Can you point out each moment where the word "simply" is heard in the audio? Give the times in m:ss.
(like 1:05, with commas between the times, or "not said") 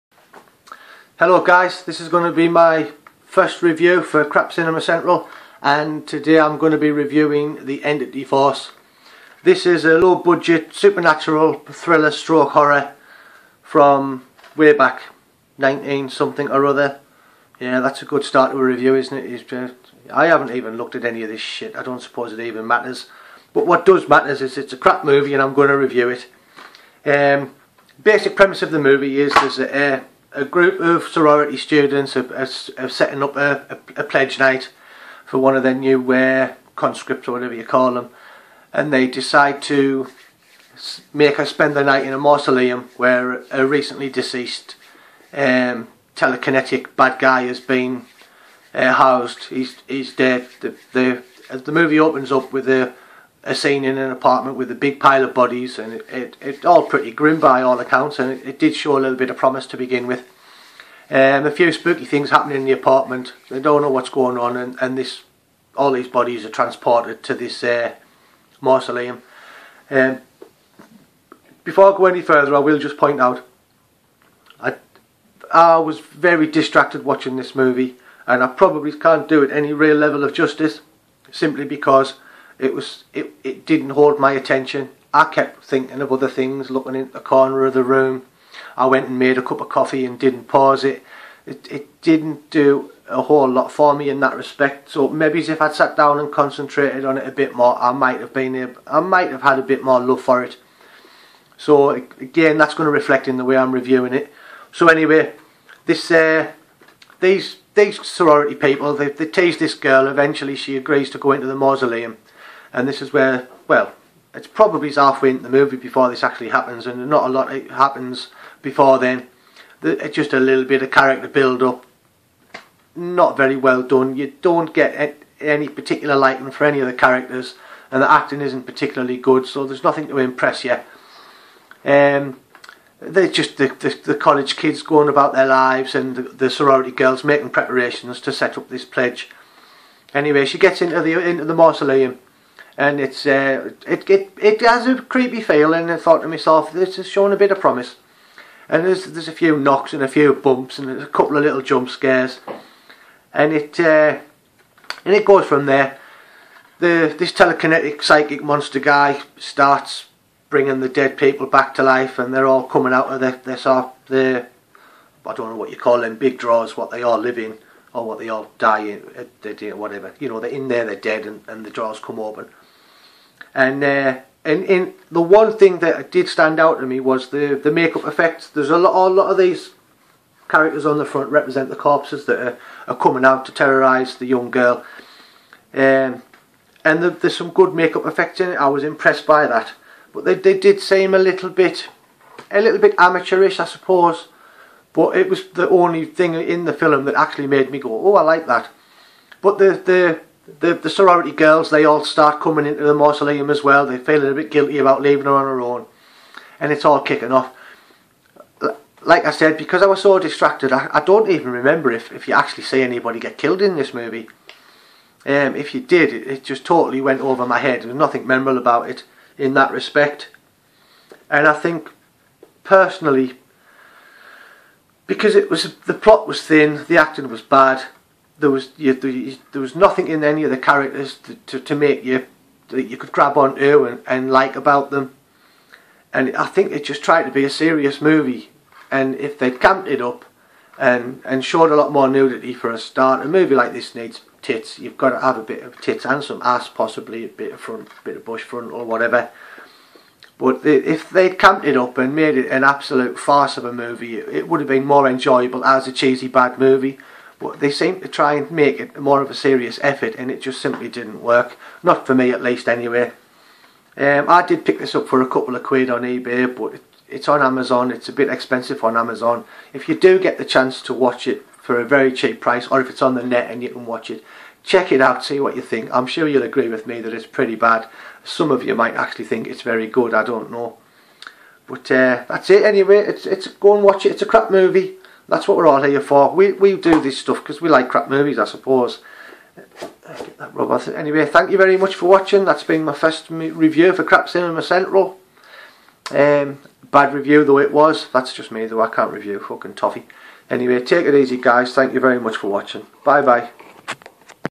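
1:21, 4:20.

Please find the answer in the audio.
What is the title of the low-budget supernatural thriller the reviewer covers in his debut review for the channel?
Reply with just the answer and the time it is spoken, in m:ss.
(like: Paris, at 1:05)
The Entity Force, at 0:07.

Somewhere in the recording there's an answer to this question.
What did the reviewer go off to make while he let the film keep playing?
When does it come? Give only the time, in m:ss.
1:29.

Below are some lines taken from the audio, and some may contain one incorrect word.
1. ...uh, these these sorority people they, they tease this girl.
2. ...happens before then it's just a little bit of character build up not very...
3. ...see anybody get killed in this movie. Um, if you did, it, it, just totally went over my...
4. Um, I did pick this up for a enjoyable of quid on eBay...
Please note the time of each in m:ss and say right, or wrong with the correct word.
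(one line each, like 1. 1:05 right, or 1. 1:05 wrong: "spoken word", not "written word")
1. 1:46 right
2. 1:57 right
3. 3:32 right
4. 4:23 wrong: "couple", not "enjoyable".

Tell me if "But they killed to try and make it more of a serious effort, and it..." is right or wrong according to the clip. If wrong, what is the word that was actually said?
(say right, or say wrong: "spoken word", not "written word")
wrong: "seemed", not "killed".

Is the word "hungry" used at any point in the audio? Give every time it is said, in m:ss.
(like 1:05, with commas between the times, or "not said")
not said.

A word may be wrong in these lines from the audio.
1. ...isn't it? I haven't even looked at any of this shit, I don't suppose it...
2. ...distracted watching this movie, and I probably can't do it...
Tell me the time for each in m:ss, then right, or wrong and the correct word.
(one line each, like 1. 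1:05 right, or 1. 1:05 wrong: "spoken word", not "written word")
1. 0:18 right
2. 1:16 right.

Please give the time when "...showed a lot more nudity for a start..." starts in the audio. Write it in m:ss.
4:01.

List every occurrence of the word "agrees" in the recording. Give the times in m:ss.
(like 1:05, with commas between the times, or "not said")
1:50, 4:36.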